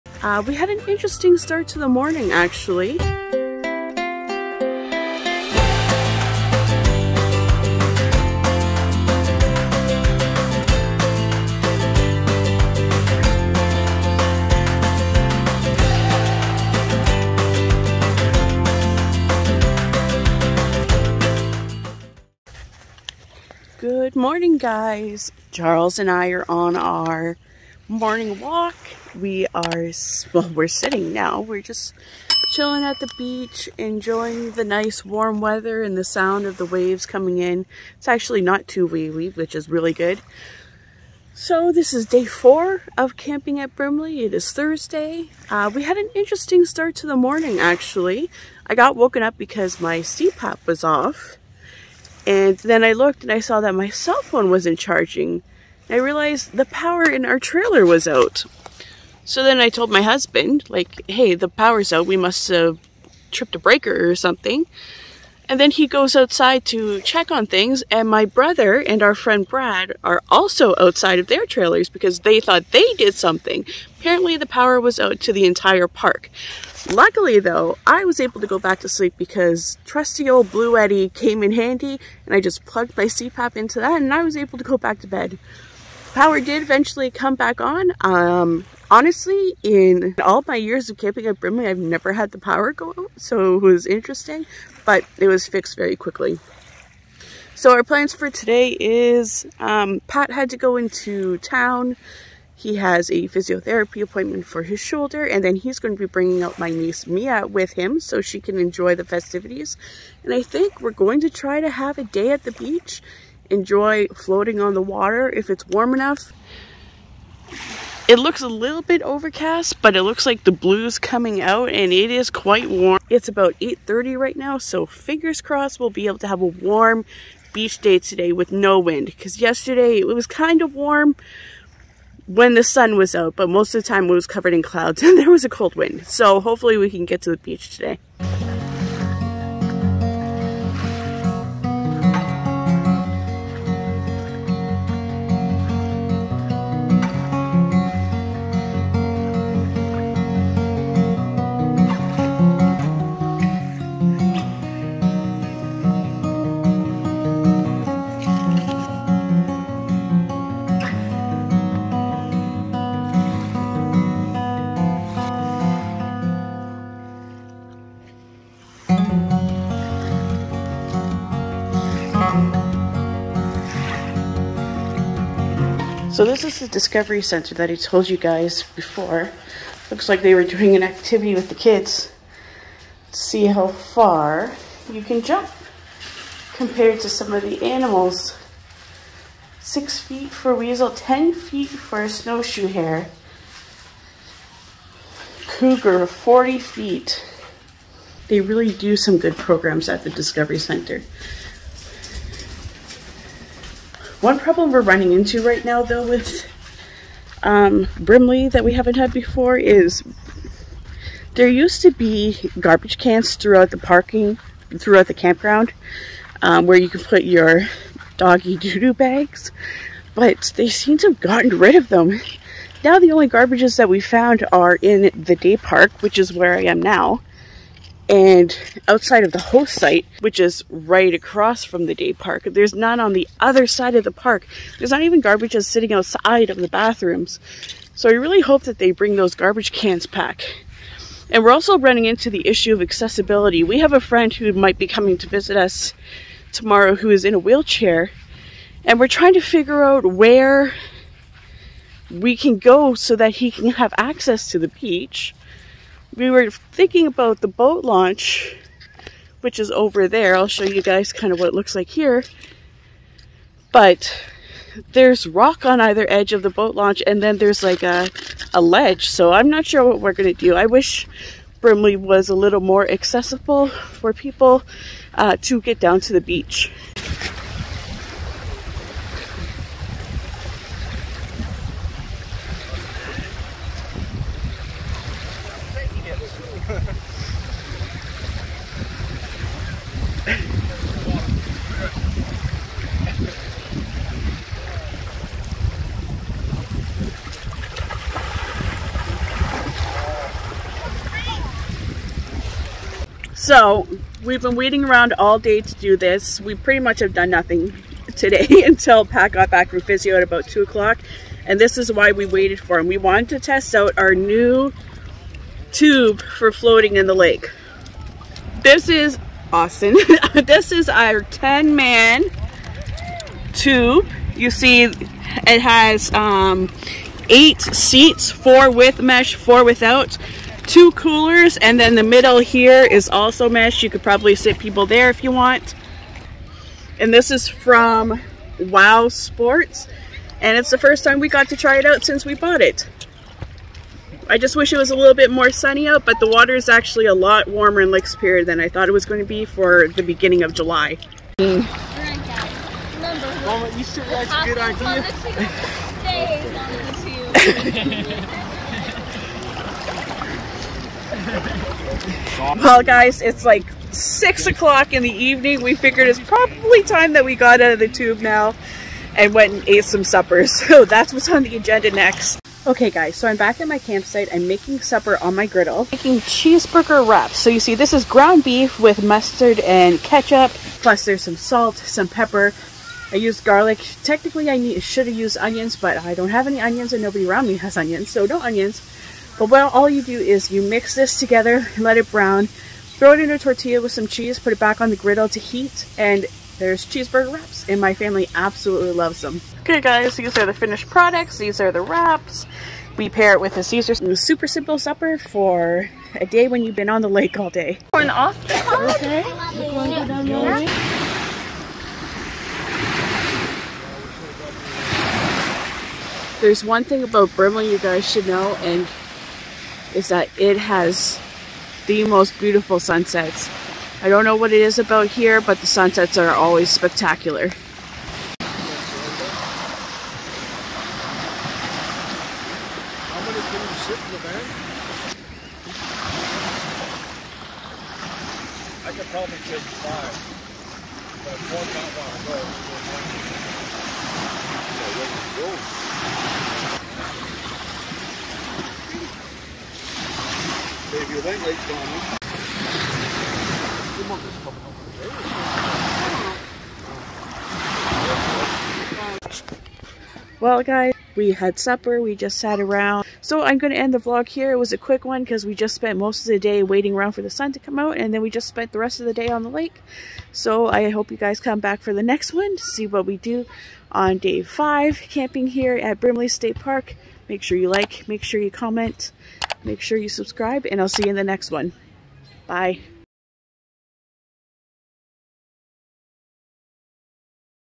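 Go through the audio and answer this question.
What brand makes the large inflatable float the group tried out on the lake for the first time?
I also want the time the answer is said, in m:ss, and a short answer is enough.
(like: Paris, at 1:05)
Wow Sports, at 5:38.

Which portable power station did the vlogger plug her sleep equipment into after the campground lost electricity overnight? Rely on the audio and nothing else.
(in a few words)
Bluetti.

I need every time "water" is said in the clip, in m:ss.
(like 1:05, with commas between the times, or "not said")
1:54, 5:46.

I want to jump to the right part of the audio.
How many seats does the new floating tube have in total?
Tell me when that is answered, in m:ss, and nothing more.
5:27.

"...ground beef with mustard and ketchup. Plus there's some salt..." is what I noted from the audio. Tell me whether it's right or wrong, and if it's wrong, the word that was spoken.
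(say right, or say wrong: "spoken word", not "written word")
right.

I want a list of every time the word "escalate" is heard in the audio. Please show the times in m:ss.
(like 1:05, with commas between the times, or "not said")
not said.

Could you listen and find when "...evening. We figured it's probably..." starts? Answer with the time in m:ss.
6:05.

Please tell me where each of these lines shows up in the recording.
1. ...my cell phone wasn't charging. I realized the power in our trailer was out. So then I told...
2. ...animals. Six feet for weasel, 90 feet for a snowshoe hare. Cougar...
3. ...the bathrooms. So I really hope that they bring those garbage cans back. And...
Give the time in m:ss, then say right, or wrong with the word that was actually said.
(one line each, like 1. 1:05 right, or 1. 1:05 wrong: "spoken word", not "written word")
1. 0:53 right
2. 3:07 wrong: "10", not "90"
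3. 3:56 right.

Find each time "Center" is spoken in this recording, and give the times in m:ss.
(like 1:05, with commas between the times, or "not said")
2:57, 3:20.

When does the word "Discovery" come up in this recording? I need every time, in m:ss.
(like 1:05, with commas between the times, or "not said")
2:56, 3:20.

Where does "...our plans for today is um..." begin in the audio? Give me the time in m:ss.
1:37.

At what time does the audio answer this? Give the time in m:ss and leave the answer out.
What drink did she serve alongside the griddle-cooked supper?
6:43.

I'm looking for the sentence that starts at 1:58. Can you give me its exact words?
It looks a little bit overcast, but it looks like the blue's coming out and it is quite warm.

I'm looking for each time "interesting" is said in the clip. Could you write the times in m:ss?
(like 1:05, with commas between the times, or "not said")
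0:00, 0:46, 1:33.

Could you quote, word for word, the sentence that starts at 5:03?
So we've been waiting around all day to do this.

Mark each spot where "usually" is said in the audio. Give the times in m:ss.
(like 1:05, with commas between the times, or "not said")
not said.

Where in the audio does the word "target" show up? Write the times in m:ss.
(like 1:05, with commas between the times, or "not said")
not said.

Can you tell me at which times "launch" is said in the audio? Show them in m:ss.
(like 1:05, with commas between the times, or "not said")
4:17, 4:26.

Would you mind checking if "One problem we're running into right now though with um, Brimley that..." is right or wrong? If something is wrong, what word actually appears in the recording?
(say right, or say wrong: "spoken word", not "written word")
right.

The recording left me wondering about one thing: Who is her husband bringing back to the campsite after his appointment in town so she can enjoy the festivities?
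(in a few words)
Mia.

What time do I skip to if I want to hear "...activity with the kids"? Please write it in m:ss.
3:00.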